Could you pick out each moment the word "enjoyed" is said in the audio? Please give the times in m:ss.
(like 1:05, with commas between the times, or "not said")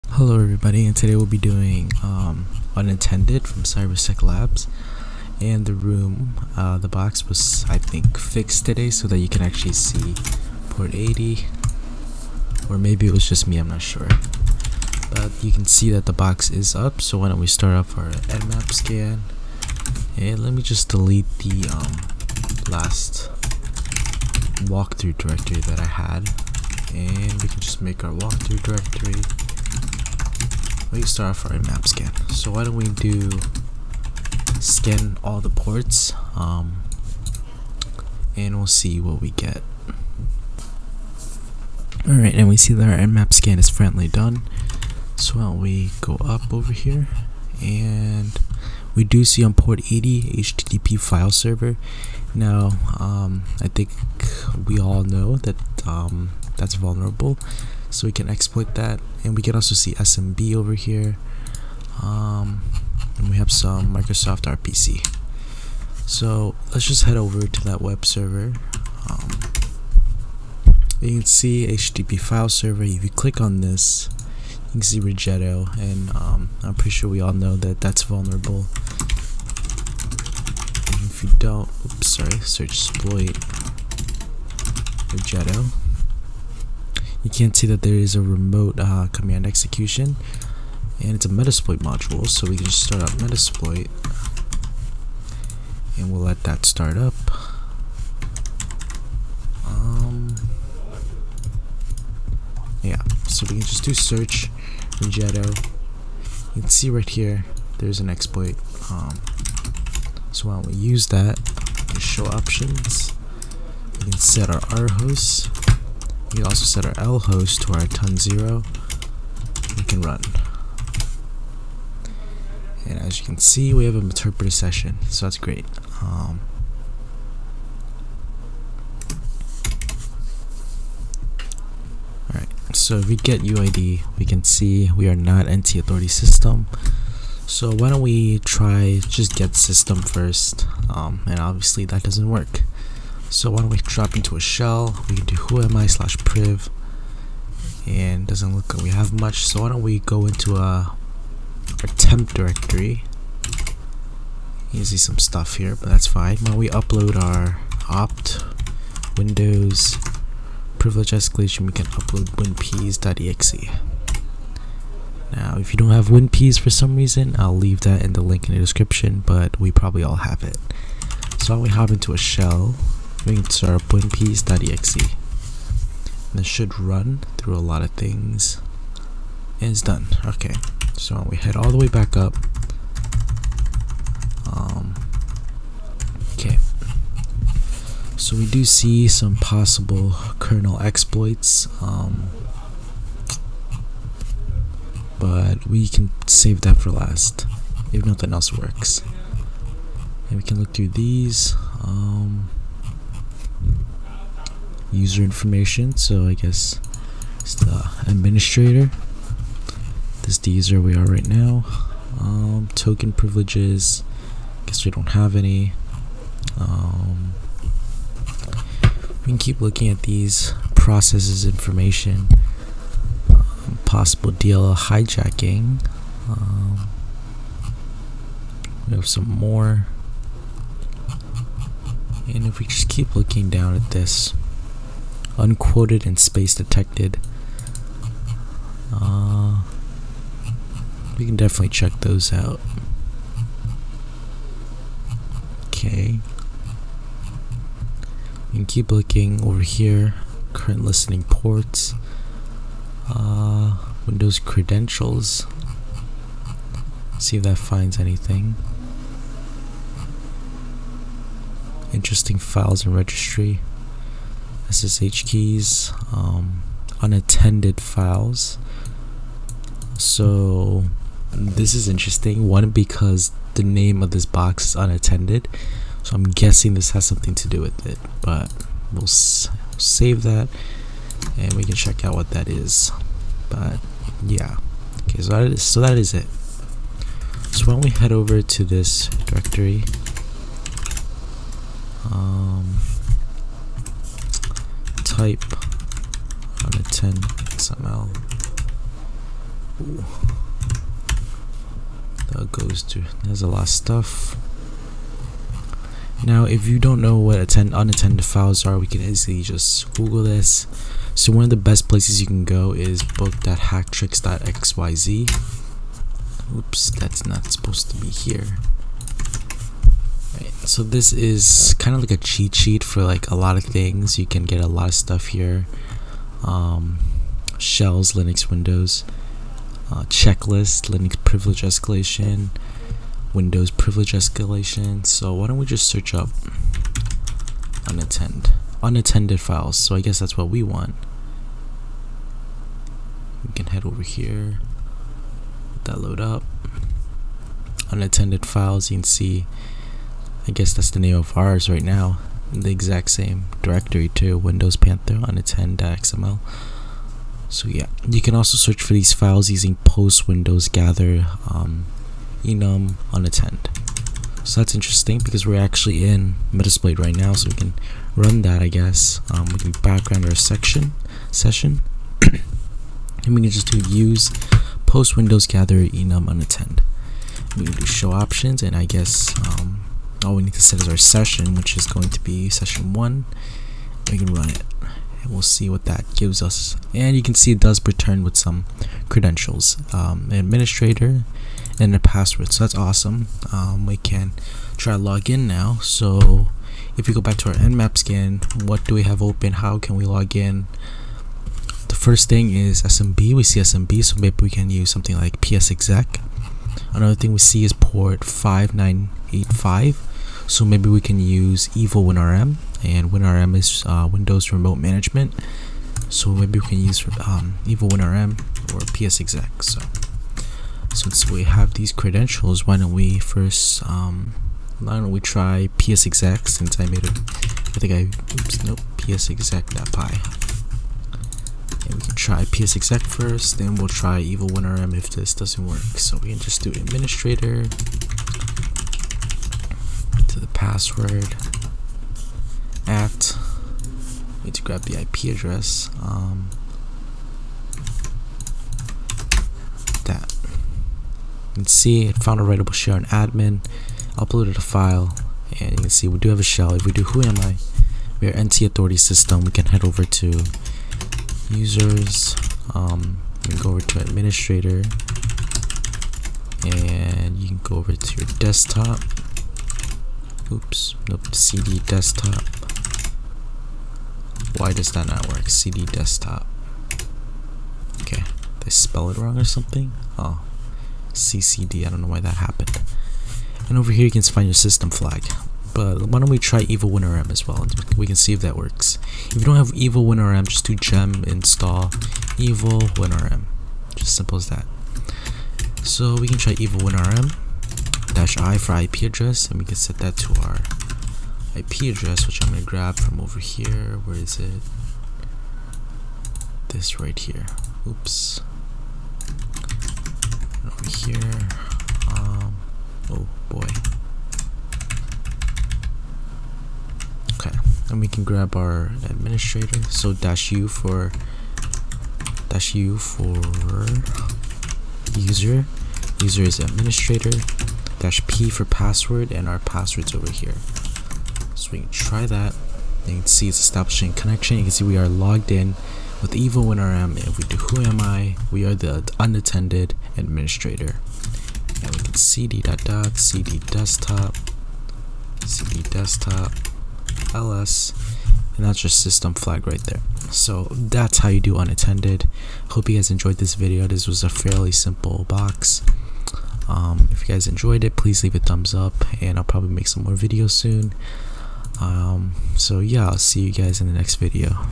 9:13, 9:17.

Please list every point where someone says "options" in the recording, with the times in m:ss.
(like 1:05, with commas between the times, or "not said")
1:52, 6:18.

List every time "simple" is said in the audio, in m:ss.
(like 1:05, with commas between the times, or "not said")
8:14, 9:14.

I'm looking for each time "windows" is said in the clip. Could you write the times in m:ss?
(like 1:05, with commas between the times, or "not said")
2:39, 4:14, 5:28, 5:33, 5:54, 6:00, 6:15, 6:54.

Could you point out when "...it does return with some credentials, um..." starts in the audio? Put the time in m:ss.
6:27.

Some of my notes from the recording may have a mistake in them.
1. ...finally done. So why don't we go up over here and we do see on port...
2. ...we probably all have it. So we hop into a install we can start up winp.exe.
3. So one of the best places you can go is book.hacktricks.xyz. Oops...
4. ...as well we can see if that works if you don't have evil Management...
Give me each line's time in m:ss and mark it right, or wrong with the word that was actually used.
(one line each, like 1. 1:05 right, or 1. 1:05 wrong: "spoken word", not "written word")
1. 0:43 right
2. 2:49 wrong: "shell", not "install"
3. 5:11 right
4. 8:07 wrong: "WinRM", not "Management".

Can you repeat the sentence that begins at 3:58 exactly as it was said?
Uh, we can definitely check those out.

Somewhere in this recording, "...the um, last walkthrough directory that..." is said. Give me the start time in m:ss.
0:21.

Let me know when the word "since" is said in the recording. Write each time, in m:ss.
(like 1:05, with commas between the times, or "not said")
7:00, 7:06.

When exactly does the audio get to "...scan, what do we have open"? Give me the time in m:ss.
6:37.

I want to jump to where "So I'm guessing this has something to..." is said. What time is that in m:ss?
4:36.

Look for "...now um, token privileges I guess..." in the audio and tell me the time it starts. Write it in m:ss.
3:31.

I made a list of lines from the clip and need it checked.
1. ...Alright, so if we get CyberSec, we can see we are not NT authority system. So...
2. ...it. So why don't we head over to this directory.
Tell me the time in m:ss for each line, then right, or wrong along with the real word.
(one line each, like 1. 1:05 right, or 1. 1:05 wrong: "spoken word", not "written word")
1. 2:12 wrong: "UID", not "CyberSec"
2. 4:46 right.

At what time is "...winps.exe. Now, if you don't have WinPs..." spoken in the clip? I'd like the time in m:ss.
2:42.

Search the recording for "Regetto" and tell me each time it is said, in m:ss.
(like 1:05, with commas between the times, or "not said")
1:15, 1:25.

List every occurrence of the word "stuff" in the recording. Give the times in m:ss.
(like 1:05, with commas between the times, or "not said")
2:35, 5:03, 5:24.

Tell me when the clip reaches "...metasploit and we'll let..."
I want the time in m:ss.
1:33.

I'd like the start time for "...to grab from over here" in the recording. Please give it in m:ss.
8:22.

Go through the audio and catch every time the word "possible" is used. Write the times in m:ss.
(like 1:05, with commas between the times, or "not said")
3:09, 3:43.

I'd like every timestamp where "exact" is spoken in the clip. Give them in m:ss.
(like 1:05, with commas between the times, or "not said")
5:52.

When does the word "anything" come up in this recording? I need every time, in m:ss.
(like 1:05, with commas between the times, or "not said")
4:17.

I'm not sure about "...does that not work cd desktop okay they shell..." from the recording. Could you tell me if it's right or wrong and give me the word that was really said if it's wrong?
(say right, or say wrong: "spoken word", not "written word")
wrong: "spell", not "shell".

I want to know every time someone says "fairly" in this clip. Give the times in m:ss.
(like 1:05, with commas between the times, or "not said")
9:14.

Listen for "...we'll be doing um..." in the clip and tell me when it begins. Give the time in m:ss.
0:01.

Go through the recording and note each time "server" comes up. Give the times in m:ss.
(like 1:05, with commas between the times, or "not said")
0:51, 1:08, 1:12.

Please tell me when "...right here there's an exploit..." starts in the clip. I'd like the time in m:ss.
1:46.